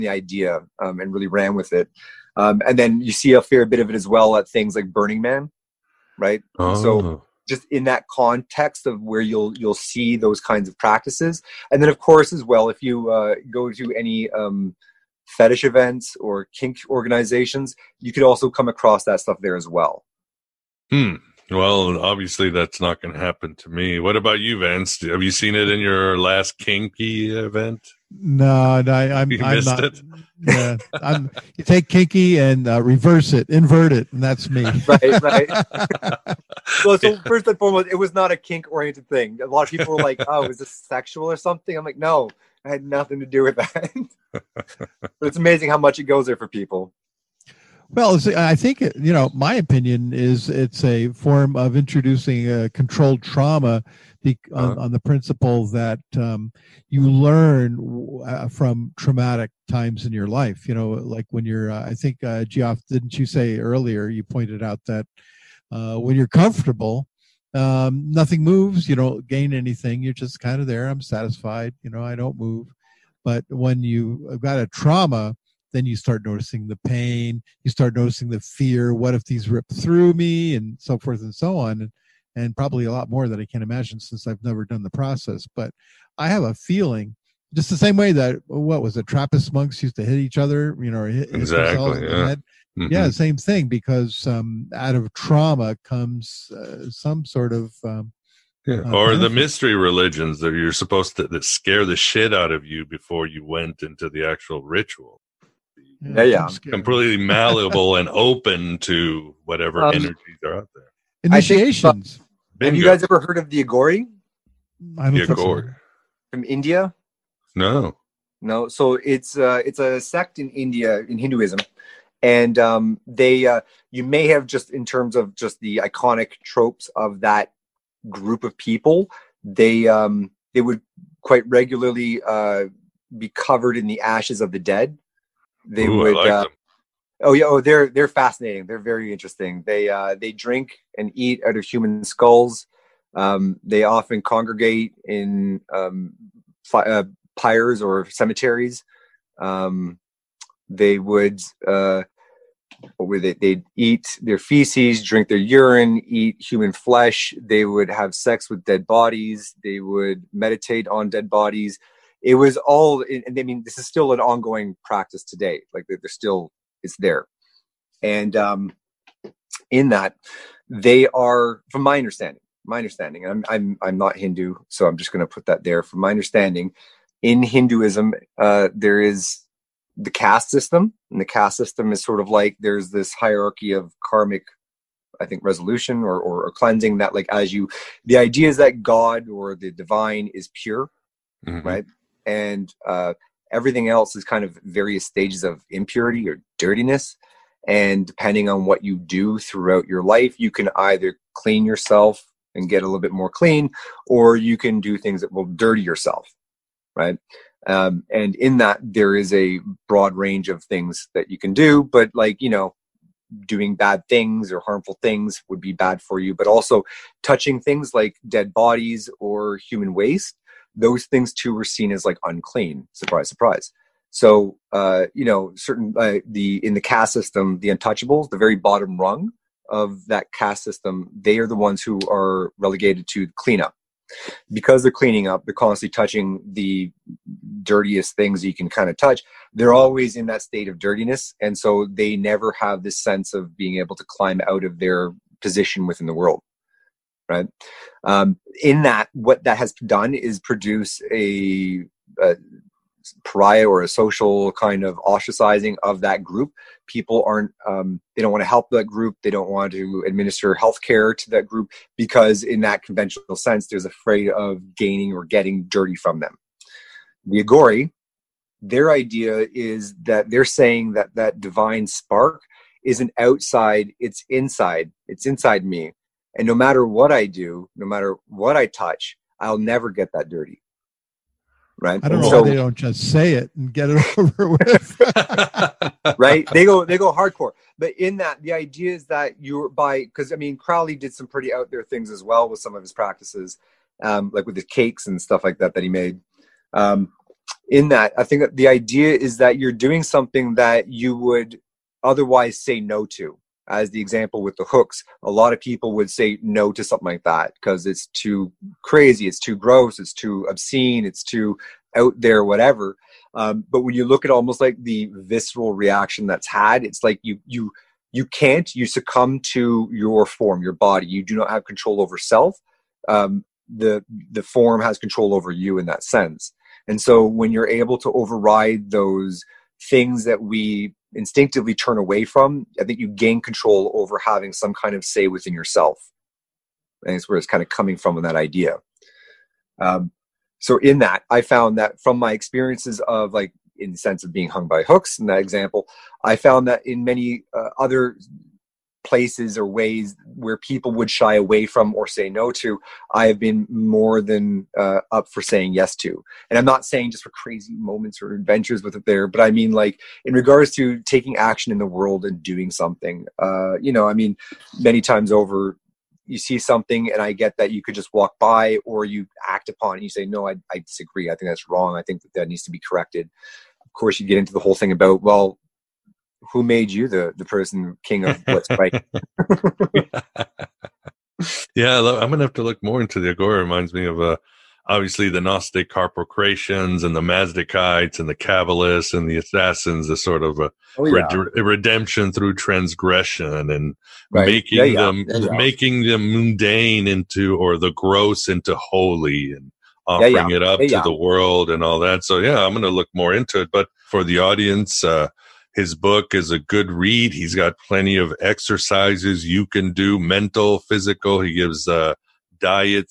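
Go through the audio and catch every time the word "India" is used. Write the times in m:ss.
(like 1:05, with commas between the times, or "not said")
1:56, 2:00.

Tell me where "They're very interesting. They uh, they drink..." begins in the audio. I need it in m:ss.
2:18.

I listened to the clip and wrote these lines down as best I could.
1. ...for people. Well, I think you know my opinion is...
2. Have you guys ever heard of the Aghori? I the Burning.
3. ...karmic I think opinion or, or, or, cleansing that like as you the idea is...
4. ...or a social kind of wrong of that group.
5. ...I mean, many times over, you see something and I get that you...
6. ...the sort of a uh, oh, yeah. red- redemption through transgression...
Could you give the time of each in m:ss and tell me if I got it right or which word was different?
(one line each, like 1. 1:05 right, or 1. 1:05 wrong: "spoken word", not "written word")
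1. 0:46 right
2. 1:52 wrong: "Aghori", not "Burning"
3. 3:04 wrong: "resolution", not "opinion"
4. 4:13 wrong: "ostracizing", not "wrong"
5. 6:04 right
6. 6:30 right.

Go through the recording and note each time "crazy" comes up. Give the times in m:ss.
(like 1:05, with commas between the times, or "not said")
5:08, 5:57.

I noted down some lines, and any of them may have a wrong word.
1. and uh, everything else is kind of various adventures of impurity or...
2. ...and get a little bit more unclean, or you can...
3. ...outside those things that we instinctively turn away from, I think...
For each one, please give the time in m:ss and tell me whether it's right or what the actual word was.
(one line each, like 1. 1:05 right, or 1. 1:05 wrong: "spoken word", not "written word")
1. 3:12 wrong: "stages", not "adventures"
2. 3:22 wrong: "clean", not "unclean"
3. 5:28 wrong: "override", not "outside".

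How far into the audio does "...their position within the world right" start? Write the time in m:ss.
4:04.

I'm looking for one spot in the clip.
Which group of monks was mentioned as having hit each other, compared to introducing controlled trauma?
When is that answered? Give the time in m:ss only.
1:29.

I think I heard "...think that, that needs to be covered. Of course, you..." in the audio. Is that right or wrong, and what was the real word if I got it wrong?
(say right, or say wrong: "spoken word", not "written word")
wrong: "corrected", not "covered".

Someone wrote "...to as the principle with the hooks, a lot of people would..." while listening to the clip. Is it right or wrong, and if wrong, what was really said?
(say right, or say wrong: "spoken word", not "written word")
wrong: "example", not "principle".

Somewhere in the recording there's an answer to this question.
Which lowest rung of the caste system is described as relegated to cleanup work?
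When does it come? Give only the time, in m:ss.
3:47.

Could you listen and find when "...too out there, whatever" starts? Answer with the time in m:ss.
5:11.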